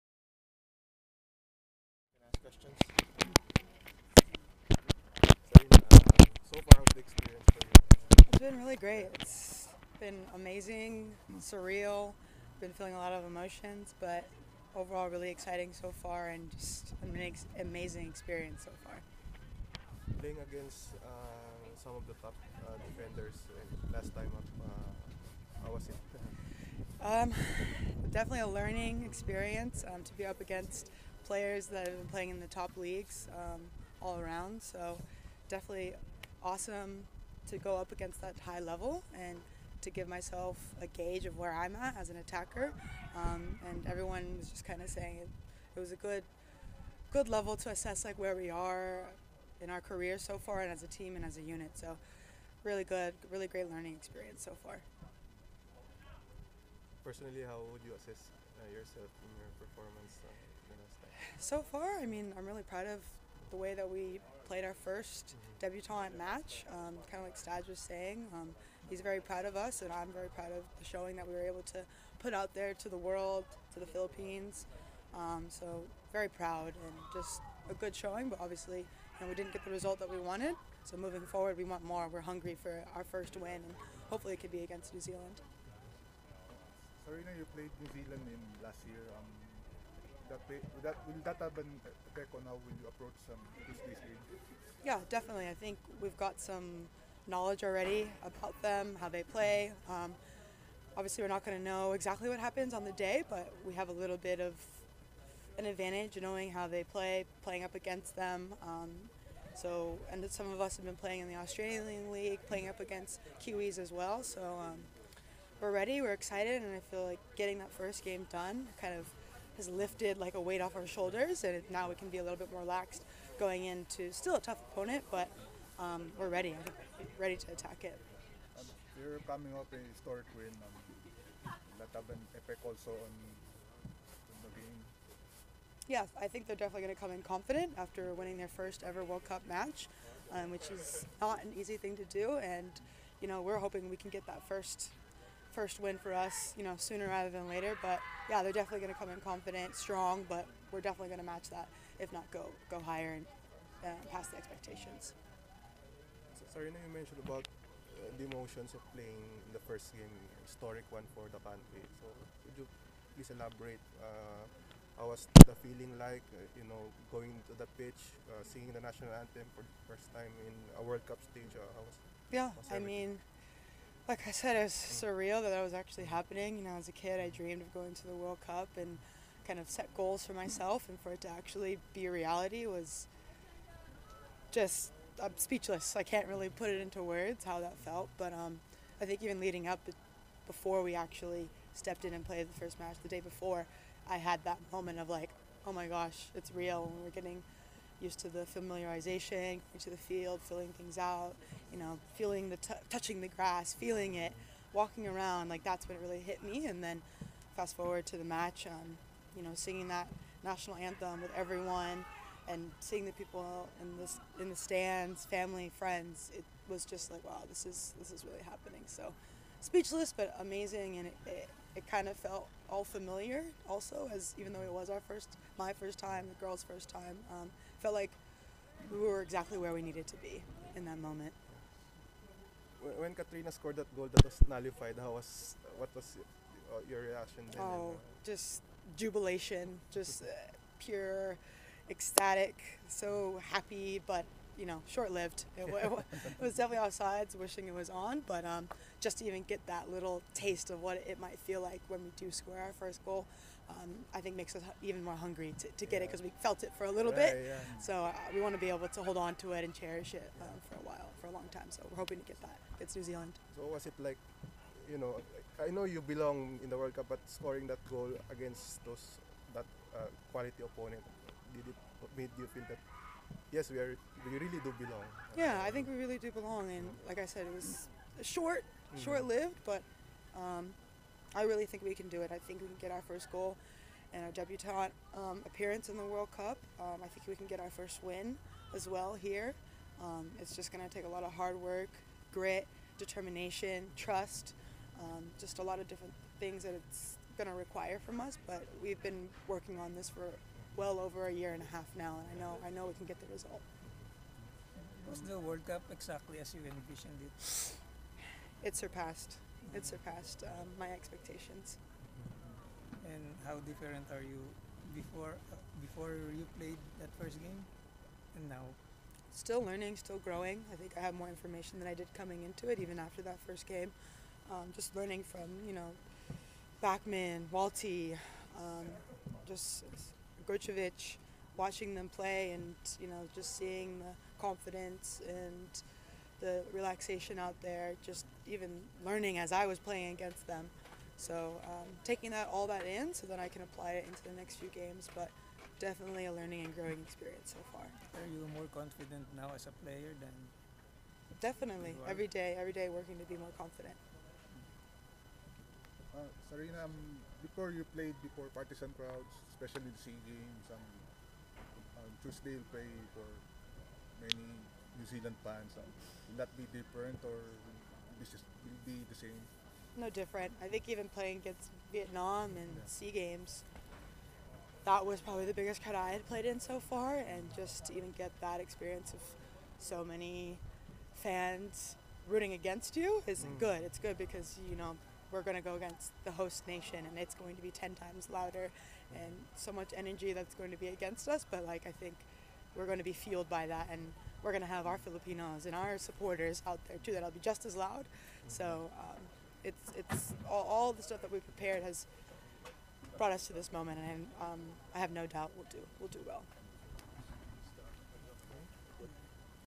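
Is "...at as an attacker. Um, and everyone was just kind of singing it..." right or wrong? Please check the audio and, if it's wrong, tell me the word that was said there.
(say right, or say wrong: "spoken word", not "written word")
wrong: "saying", not "singing".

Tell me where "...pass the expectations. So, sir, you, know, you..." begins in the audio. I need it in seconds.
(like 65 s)
154 s.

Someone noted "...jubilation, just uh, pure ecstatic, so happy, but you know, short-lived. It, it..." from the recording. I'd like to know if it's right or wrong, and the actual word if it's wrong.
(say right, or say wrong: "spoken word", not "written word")
right.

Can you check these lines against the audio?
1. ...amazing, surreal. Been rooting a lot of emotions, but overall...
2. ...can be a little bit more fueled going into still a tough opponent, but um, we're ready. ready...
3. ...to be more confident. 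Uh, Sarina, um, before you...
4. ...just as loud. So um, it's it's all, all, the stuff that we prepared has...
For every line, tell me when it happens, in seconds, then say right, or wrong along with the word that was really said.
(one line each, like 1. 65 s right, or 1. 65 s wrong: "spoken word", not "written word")
1. 10 s wrong: "feeling", not "rooting"
2. 121 s wrong: "relaxed", not "fueled"
3. 353 s right
4. 397 s right.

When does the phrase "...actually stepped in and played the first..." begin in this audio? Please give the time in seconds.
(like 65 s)
190 s.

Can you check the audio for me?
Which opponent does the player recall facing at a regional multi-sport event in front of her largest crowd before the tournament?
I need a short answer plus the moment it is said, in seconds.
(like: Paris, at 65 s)
Vietnam, at 371 s.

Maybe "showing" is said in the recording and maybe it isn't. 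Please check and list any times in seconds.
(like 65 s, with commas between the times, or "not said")
70 s, 77 s.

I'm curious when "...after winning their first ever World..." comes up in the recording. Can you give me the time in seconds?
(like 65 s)
137 s.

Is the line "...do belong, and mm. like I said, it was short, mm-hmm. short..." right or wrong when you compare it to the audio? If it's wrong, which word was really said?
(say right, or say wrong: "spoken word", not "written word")
right.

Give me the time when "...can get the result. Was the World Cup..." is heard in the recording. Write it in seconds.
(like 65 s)
302 s.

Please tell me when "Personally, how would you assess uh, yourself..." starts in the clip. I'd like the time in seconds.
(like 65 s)
57 s.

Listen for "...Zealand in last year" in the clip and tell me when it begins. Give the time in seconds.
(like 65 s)
88 s.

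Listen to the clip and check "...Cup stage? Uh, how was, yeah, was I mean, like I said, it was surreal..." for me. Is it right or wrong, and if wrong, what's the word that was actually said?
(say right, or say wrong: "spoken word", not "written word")
right.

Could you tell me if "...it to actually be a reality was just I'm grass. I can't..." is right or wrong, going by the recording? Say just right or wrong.
wrong.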